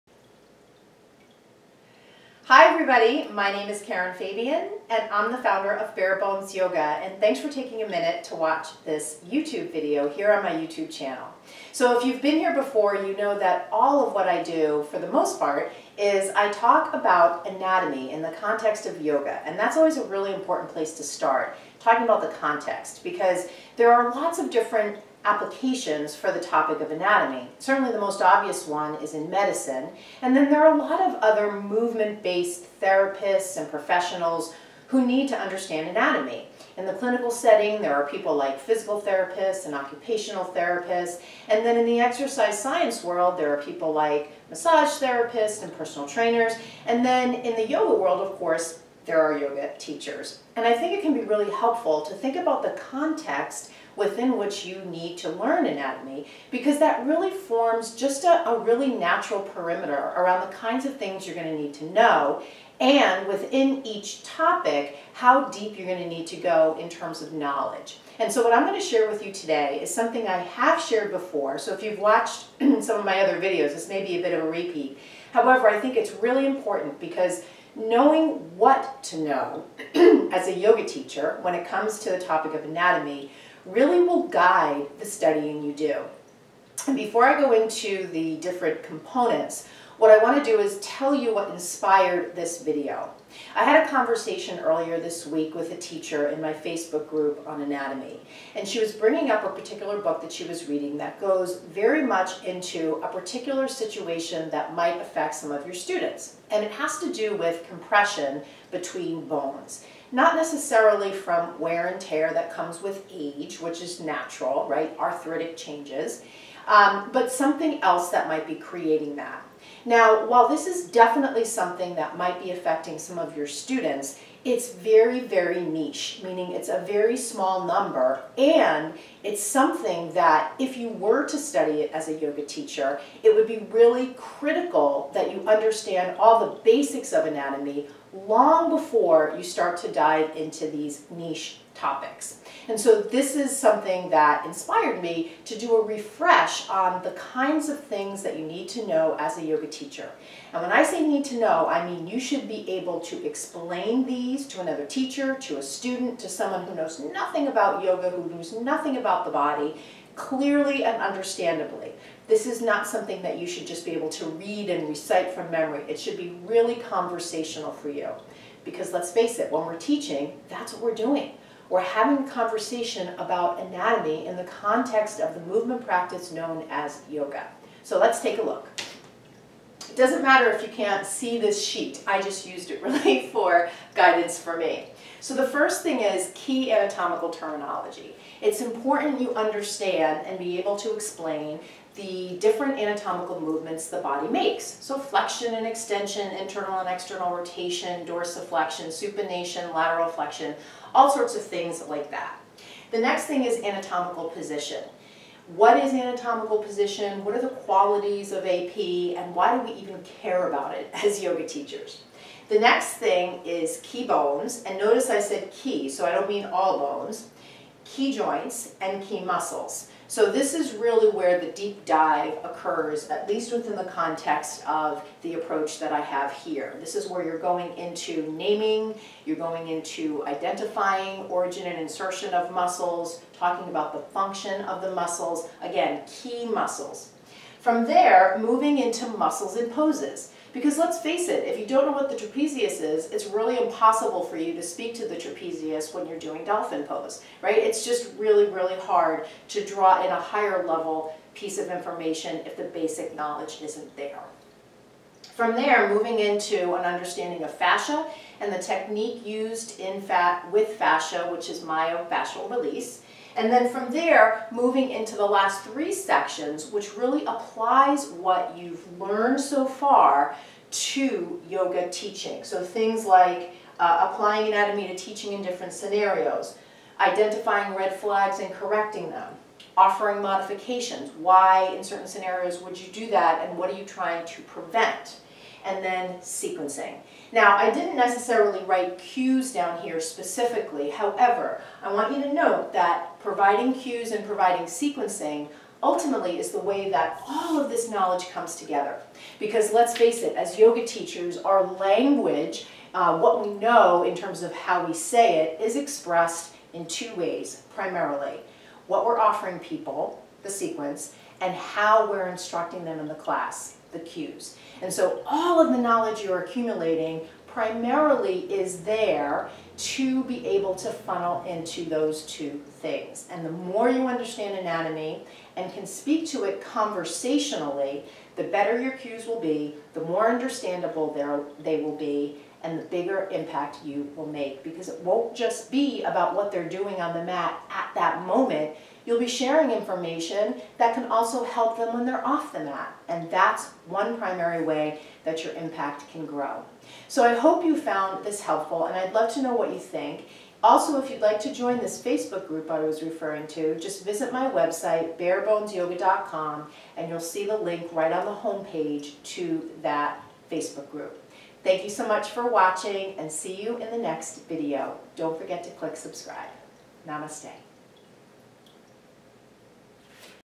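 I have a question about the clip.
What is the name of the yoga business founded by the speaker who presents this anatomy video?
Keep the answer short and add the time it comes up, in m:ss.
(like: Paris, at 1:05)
Bare Bones Yoga, at 0:05.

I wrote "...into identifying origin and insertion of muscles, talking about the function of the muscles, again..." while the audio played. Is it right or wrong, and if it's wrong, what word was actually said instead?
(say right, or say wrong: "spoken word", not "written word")
right.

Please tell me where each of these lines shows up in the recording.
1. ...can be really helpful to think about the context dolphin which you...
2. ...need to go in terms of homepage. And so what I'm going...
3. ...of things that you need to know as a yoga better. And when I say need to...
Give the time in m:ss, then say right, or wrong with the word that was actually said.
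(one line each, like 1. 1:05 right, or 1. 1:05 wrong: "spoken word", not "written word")
1. 0:51 wrong: "within", not "dolphin"
2. 1:06 wrong: "knowledge", not "homepage"
3. 2:27 wrong: "teacher", not "better".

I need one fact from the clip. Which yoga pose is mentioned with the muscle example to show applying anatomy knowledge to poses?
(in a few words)
Dolphin pose.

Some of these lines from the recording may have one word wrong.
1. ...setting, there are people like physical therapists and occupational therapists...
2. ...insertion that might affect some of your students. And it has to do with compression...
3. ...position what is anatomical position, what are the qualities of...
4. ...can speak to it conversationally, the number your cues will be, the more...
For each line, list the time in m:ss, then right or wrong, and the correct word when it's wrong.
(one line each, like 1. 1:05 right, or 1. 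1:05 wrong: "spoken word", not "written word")
1. 0:37 right
2. 1:43 wrong: "situation", not "insertion"
3. 3:24 right
4. 5:25 wrong: "better", not "number".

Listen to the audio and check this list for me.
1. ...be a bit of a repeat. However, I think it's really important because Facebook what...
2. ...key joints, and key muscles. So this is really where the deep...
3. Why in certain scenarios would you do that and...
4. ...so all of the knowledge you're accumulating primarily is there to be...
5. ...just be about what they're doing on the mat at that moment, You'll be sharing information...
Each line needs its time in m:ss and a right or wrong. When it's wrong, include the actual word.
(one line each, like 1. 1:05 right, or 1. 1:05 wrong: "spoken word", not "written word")
1. 1:14 wrong: "Knowing", not "Facebook"
2. 3:37 right
3. 4:41 right
4. 5:14 right
5. 5:35 right.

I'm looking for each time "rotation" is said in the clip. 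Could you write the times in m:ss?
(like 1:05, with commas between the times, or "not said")
3:17.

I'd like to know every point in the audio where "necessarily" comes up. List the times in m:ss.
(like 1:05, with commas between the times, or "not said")
1:50, 4:47.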